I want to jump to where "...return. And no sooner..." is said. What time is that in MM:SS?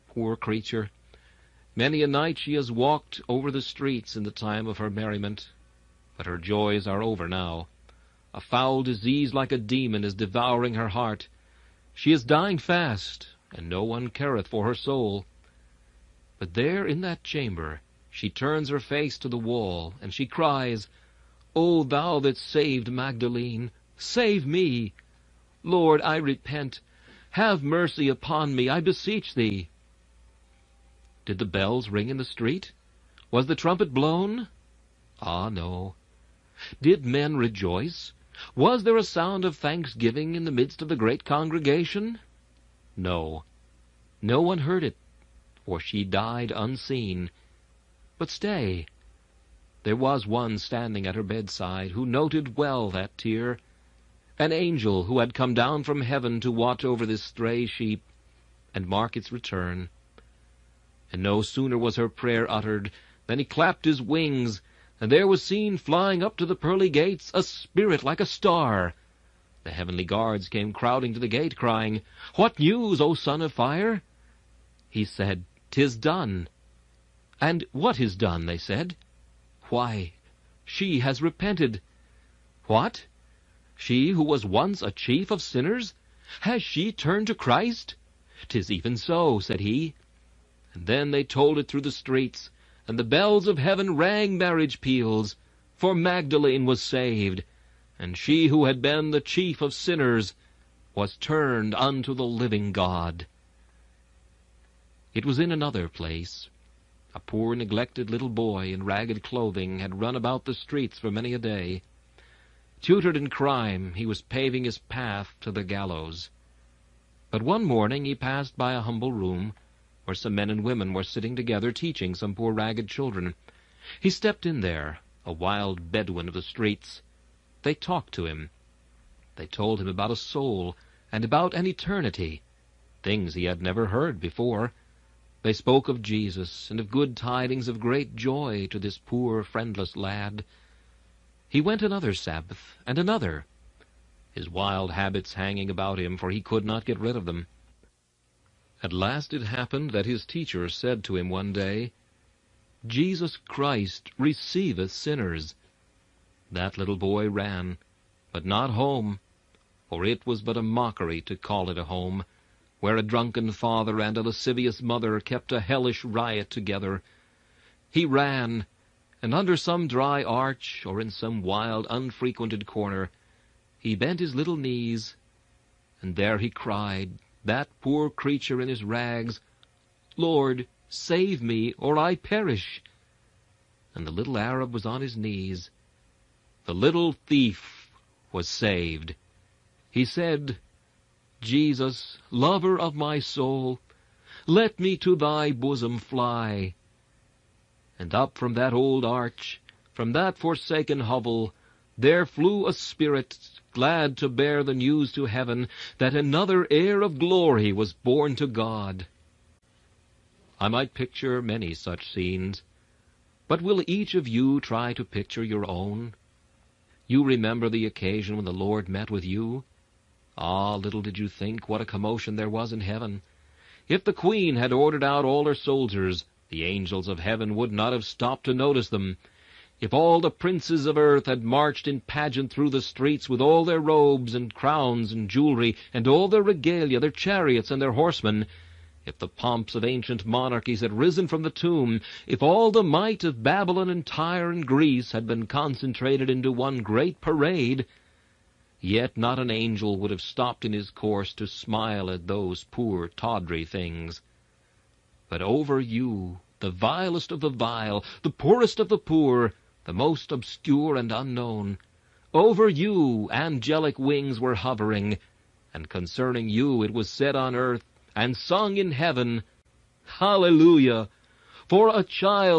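00:59.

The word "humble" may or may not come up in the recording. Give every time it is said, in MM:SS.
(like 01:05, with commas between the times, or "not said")
01:58.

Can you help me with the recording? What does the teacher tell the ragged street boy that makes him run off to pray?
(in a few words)
Jesus Christ receiveth sinners.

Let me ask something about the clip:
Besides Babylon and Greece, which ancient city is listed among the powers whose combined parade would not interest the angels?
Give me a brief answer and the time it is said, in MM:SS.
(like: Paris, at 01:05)
Tyre, at 04:04.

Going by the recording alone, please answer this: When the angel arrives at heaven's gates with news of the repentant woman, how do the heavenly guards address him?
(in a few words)
son of fire.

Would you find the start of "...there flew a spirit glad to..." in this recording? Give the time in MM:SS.
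03:21.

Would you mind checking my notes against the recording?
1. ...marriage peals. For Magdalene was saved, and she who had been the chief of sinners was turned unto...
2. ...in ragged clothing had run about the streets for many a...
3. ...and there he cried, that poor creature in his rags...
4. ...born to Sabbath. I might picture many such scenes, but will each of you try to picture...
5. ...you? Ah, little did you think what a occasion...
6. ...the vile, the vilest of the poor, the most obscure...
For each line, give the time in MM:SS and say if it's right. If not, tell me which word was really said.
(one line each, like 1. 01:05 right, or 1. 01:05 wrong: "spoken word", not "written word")
1. 01:34 right
2. 01:48 right
3. 02:56 right
4. 03:27 wrong: "God", not "Sabbath"
5. 03:39 wrong: "commotion", not "occasion"
6. 04:17 wrong: "poorest", not "vilest".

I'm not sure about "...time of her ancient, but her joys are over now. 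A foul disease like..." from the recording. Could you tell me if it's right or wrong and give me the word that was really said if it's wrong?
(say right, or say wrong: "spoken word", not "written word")
wrong: "merriment", not "ancient".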